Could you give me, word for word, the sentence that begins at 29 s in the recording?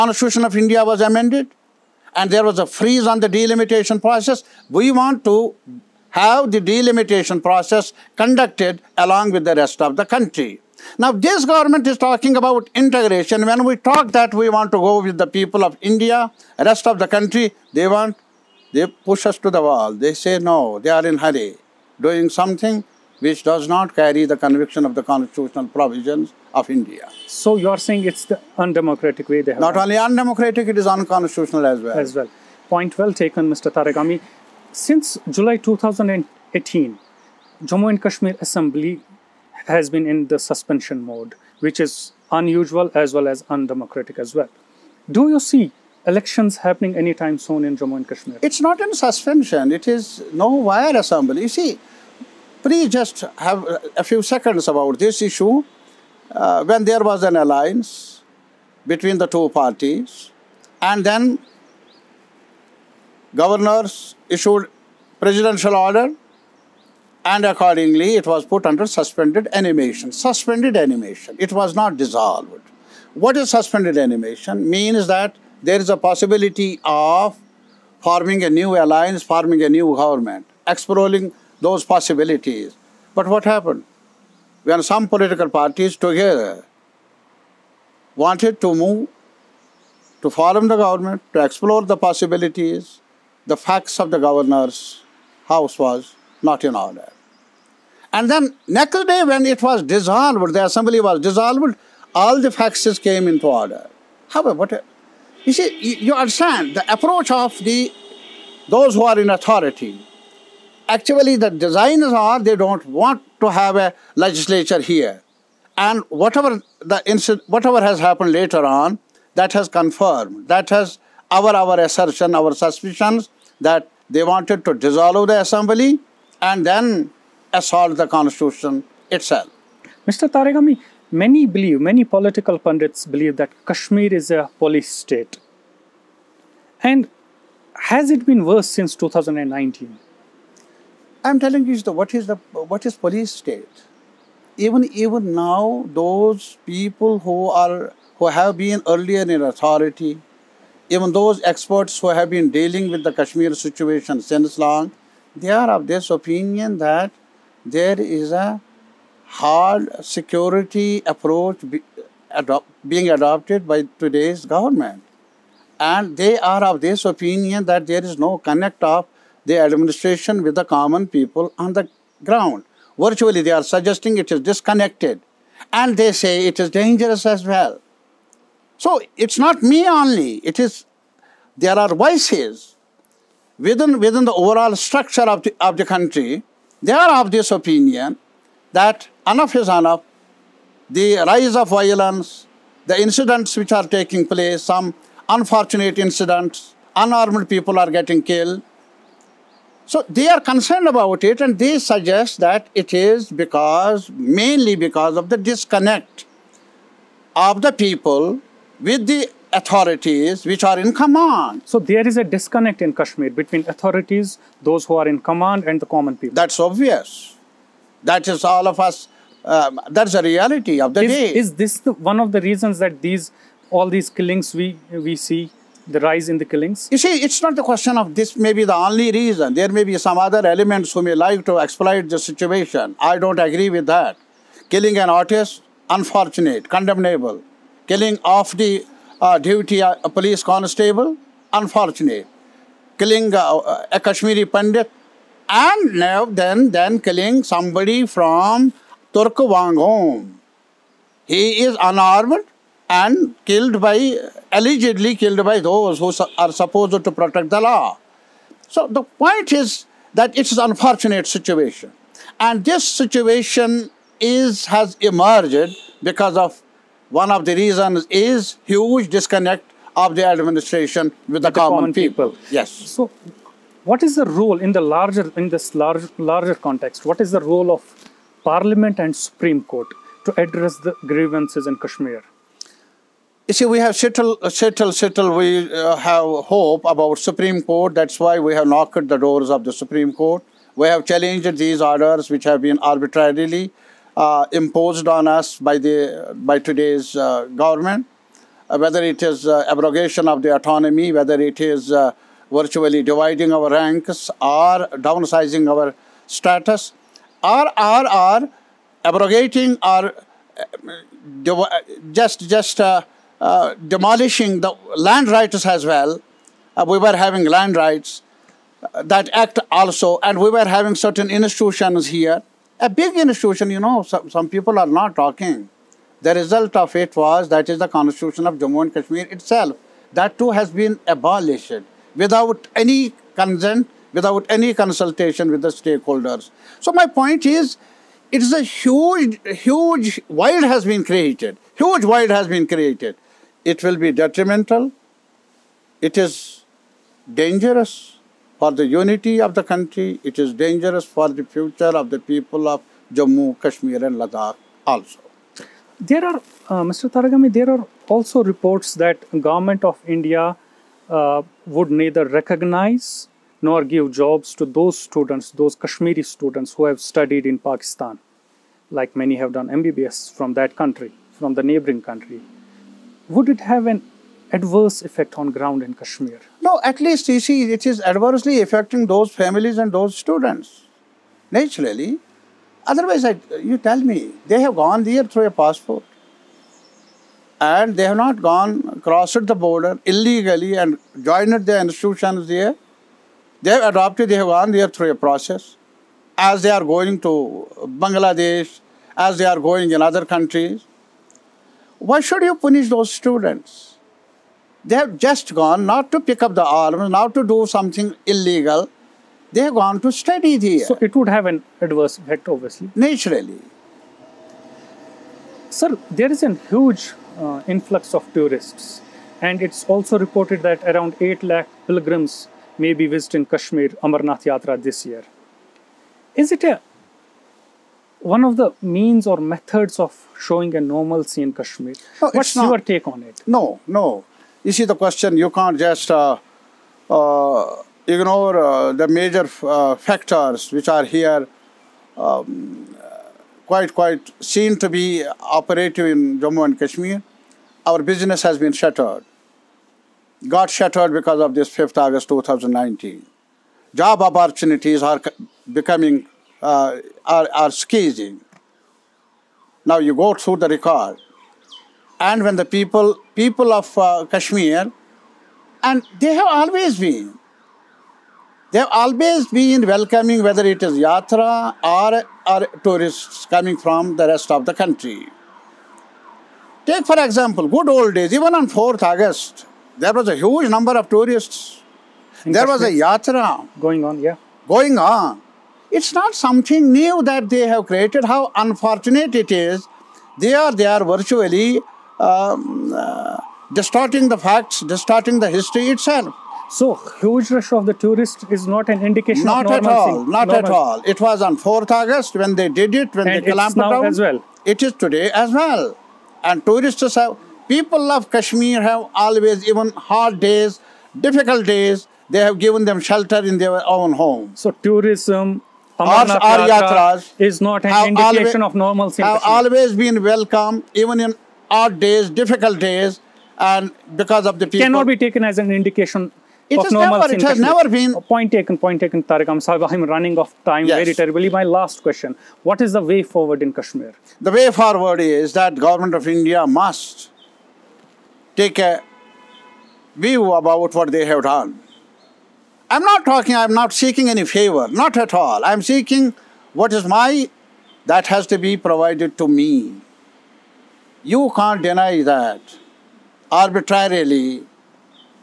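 Not only undemocratic, it is unconstitutional as well.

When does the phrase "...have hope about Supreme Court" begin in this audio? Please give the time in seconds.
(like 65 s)
285 s.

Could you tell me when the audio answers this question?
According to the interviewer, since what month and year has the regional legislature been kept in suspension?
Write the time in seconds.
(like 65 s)
35 s.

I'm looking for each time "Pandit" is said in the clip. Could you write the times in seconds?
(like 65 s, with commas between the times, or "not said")
244 s.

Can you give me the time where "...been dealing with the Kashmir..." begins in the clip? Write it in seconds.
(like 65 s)
152 s.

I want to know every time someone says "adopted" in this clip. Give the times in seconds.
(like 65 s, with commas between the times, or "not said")
163 s, 393 s.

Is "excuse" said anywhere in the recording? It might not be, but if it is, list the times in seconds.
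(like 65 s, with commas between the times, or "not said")
not said.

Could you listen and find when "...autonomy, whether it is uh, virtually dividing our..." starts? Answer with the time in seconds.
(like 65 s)
300 s.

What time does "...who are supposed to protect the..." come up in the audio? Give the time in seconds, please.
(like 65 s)
255 s.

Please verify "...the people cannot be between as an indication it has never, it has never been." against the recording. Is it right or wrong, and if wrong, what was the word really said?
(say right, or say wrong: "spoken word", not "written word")
wrong: "taken", not "between".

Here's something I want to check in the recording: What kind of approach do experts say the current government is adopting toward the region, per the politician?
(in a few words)
Hard security approach.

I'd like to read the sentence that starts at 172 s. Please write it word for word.
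Virtually, they are suggesting it is disconnected.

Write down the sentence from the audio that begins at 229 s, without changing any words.
There may be some other elements who may like to exploit the situation.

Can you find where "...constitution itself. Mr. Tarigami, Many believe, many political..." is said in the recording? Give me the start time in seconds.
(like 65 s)
128 s.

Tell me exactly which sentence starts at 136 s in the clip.
And has it been worse since 2019?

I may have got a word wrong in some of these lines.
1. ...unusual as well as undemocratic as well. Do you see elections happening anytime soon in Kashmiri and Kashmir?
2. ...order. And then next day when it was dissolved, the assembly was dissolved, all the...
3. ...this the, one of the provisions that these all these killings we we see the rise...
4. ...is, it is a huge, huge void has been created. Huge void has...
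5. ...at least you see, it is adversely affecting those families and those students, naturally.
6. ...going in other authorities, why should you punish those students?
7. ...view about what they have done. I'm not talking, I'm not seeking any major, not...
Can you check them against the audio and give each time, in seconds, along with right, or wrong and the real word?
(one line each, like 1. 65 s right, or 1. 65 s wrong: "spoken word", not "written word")
1. 42 s wrong: "Jammu", not "Kashmiri"
2. 96 s right
3. 221 s wrong: "reasons", not "provisions"
4. 337 s right
5. 376 s right
6. 399 s wrong: "countries", not "authorities"
7. 540 s wrong: "favor", not "major".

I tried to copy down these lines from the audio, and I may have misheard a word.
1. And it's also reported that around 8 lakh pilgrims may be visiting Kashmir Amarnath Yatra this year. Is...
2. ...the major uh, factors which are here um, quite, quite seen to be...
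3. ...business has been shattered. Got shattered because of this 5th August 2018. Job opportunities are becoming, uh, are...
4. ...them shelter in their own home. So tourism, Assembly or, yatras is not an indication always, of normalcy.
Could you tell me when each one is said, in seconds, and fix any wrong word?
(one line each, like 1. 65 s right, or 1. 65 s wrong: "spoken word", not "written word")
1. 419 s right
2. 438 s right
3. 448 s wrong: "2019", not "2018"
4. 512 s wrong: "Amarnath", not "Assembly".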